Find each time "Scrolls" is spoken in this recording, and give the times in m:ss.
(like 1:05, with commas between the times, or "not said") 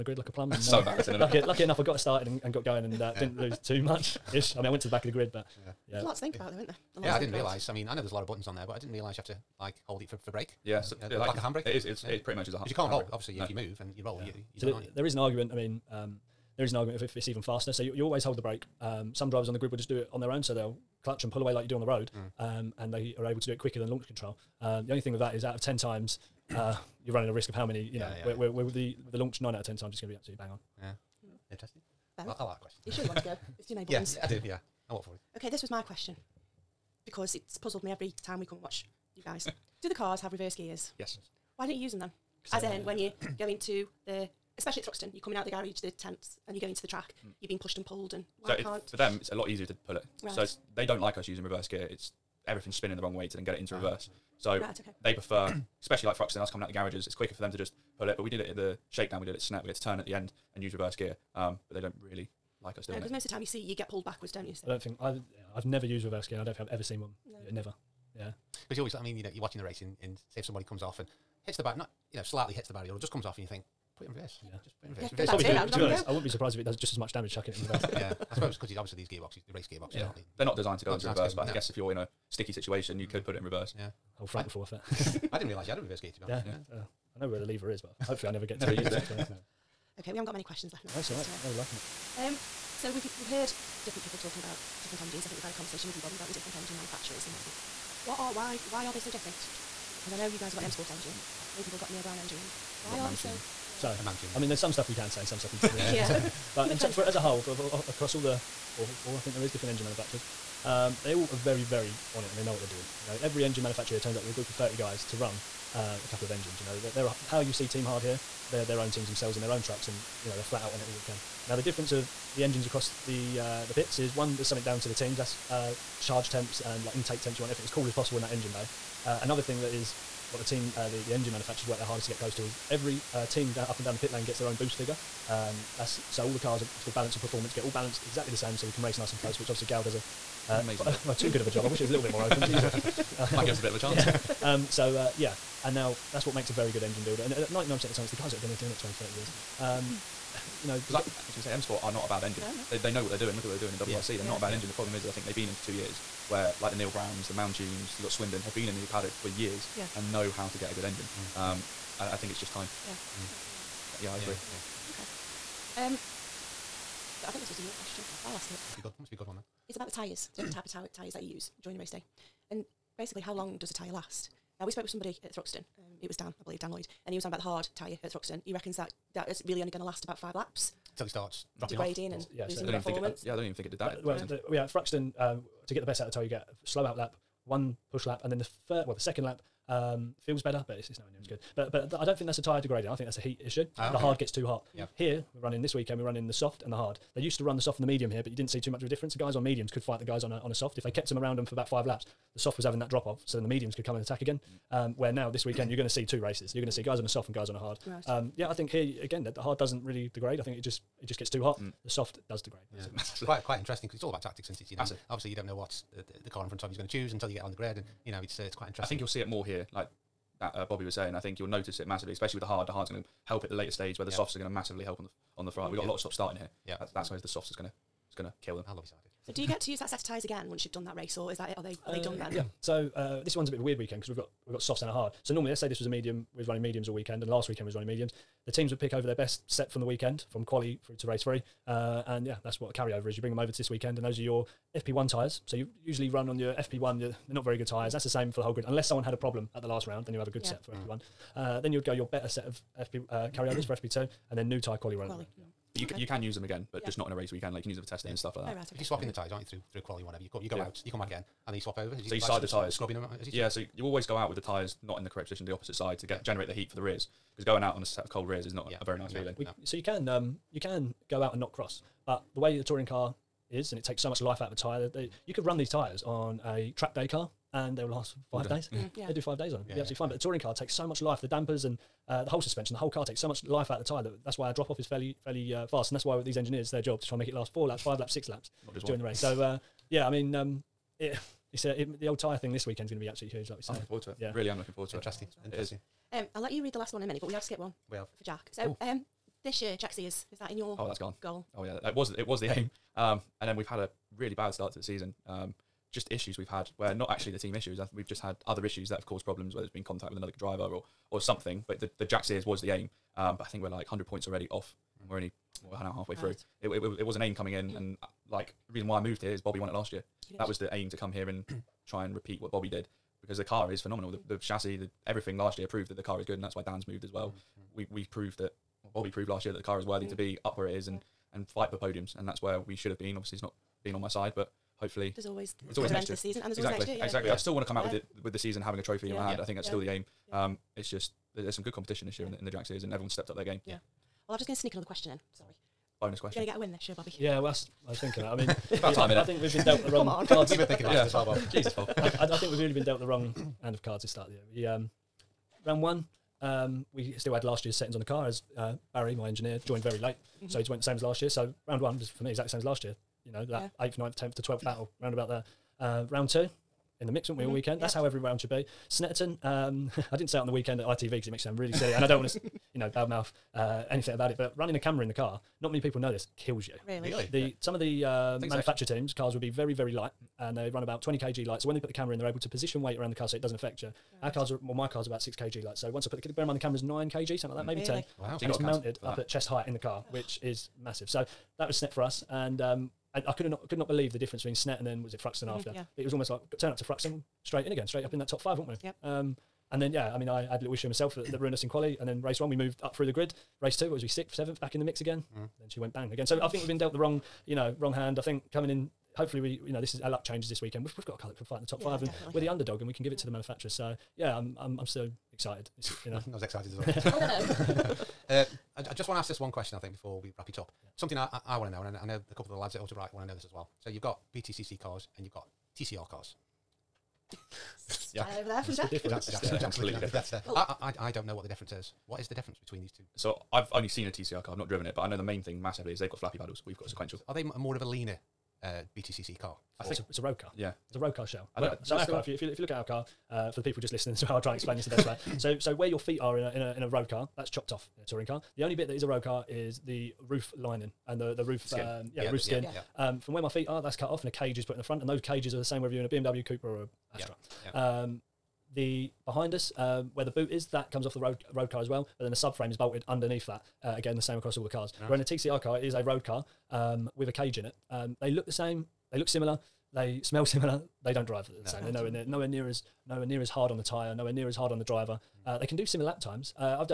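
not said.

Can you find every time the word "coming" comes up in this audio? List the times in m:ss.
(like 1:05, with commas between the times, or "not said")
0:45, 0:56, 5:17, 6:48.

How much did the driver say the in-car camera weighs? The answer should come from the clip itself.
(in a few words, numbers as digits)
9 kg.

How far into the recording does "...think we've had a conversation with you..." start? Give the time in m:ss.
1:35.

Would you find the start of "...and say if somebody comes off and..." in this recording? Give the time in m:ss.
1:10.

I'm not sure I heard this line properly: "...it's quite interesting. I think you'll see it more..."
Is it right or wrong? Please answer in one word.
right.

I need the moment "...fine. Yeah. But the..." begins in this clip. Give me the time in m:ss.
4:39.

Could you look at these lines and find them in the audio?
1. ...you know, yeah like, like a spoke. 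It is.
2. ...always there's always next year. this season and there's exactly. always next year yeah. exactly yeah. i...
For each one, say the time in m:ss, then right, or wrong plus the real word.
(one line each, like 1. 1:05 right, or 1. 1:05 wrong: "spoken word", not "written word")
1. 0:10 wrong: "handbrake", not "spoke"
2. 5:35 right.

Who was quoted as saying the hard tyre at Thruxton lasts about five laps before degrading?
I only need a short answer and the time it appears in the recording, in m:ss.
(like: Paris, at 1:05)
Dan Lloyd, at 2:56.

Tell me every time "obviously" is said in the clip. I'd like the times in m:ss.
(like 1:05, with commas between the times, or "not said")
0:13, 1:18, 2:19, 3:35, 5:33.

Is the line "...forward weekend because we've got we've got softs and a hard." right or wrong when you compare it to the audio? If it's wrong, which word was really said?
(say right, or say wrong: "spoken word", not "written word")
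wrong: "weird", not "forward".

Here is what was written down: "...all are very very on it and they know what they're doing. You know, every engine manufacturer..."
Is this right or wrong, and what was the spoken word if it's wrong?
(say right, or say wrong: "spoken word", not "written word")
right.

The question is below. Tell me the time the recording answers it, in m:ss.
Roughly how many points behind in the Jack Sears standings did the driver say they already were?
5:13.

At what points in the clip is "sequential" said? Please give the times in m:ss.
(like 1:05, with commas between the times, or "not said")
7:16.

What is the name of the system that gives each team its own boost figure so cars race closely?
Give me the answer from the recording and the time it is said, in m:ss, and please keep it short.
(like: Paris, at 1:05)
Balance of performance, at 2:16.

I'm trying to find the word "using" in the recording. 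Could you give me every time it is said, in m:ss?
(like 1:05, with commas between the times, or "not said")
0:51.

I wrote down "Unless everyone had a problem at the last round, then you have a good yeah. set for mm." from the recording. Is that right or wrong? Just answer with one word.
wrong.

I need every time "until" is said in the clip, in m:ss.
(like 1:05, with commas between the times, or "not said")
3:00, 3:37.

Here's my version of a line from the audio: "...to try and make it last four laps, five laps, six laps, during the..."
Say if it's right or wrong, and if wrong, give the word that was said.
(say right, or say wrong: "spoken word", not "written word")
right.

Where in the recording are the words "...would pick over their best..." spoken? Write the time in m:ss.
3:58.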